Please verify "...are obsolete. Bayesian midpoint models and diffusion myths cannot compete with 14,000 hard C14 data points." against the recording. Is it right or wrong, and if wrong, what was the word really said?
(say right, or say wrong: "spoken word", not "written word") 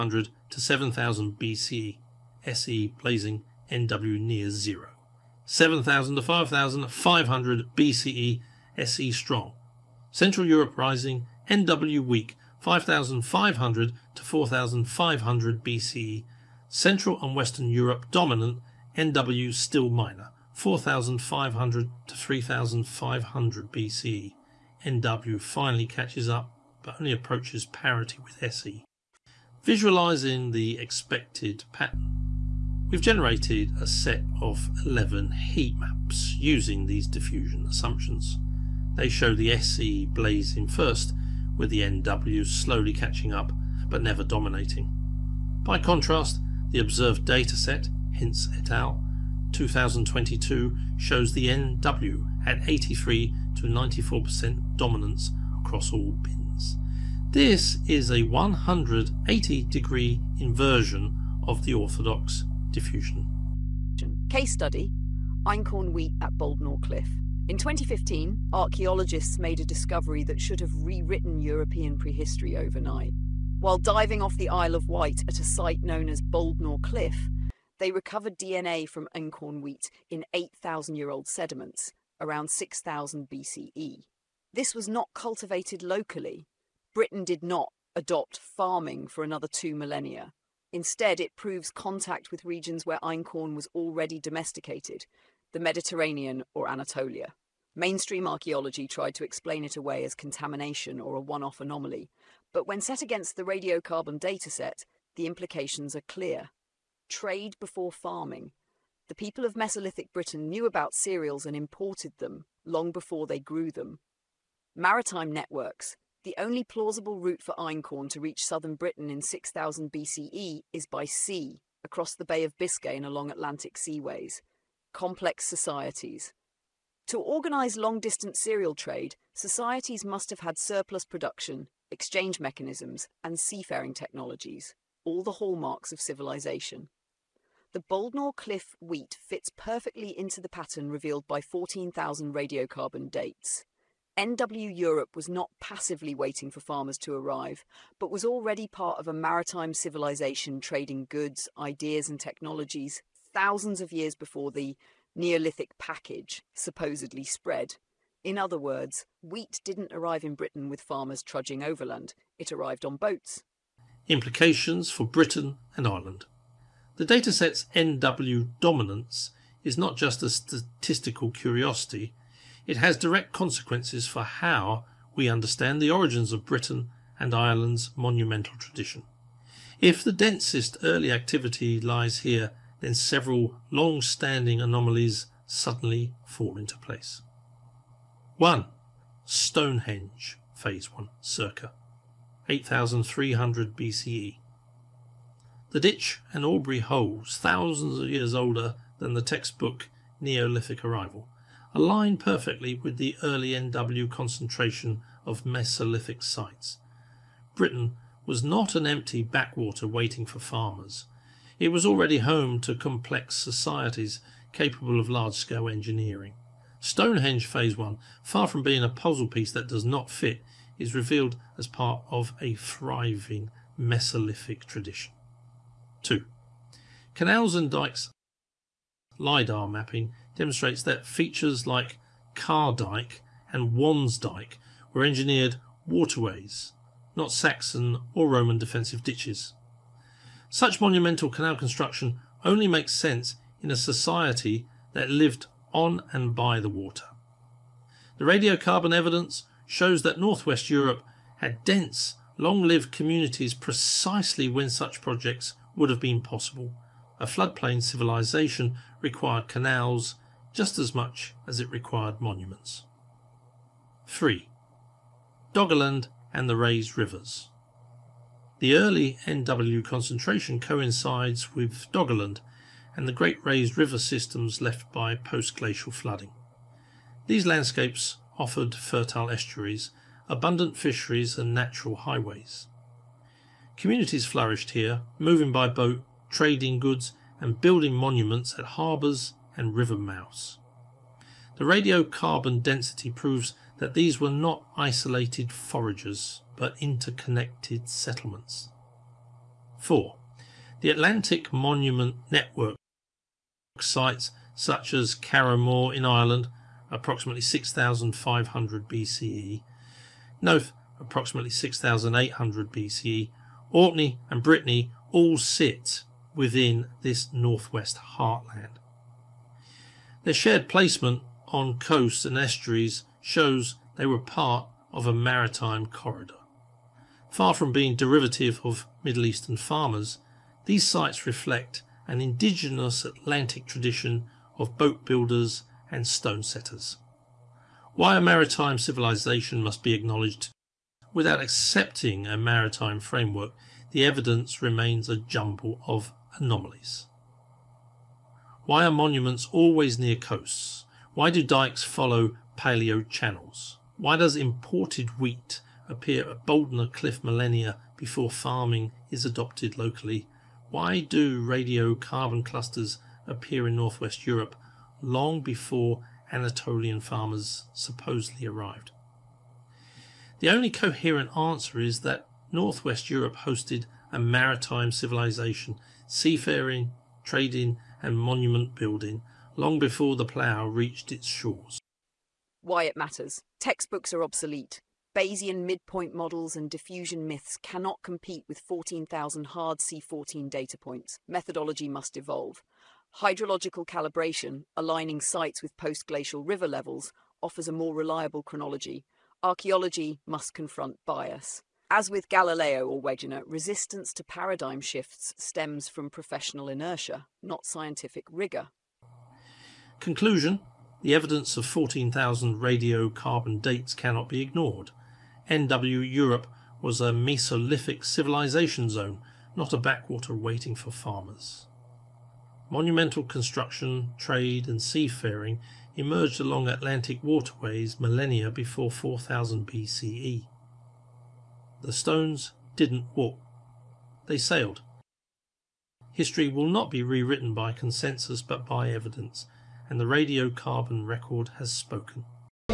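right.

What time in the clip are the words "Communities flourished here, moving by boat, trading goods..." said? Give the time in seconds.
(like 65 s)
283 s.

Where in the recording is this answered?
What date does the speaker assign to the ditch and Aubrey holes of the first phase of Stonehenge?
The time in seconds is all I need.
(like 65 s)
191 s.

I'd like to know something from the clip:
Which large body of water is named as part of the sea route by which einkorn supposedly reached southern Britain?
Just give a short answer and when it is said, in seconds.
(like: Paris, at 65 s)
Bay of Biscay, at 122 s.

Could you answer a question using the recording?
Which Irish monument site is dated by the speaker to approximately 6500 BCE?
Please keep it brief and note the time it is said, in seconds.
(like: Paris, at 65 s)
Carrowmore, at 305 s.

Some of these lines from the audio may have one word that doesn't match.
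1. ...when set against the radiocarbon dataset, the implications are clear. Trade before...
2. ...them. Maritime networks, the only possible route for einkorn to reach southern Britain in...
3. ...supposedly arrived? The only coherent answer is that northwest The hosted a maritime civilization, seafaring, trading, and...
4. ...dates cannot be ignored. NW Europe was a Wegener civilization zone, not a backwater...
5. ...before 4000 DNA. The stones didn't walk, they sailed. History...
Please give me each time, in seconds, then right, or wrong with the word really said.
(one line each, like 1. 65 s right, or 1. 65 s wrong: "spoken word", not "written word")
1. 102 s right
2. 113 s wrong: "plausible", not "possible"
3. 367 s wrong: "Europe", not "The"
4. 413 s wrong: "Mesolithic", not "Wegener"
5. 428 s wrong: "BCE", not "DNA".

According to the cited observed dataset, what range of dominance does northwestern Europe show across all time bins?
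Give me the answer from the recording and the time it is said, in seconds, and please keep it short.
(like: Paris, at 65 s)
83 to 94%, at 52 s.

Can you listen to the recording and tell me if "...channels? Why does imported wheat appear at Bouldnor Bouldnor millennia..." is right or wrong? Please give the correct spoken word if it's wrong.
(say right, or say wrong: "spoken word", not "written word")
wrong: "Cliff", not "Bouldnor".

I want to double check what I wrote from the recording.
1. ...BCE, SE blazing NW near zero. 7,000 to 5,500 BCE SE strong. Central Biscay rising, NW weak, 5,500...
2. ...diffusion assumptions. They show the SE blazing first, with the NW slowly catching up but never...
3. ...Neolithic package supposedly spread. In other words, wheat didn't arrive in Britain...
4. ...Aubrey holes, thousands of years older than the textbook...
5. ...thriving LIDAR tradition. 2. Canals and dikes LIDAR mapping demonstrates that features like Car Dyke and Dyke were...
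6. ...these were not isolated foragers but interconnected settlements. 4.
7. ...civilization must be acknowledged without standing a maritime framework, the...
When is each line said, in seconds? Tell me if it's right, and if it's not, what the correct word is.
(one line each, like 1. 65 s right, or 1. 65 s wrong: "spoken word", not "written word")
1. 1 s wrong: "Europe", not "Biscay"
2. 37 s right
3. 155 s right
4. 196 s right
5. 222 s wrong: "Mesolithic", not "LIDAR"
6. 293 s right
7. 338 s wrong: "accepting", not "standing".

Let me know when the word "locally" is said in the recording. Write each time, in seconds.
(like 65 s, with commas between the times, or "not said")
85 s, 359 s.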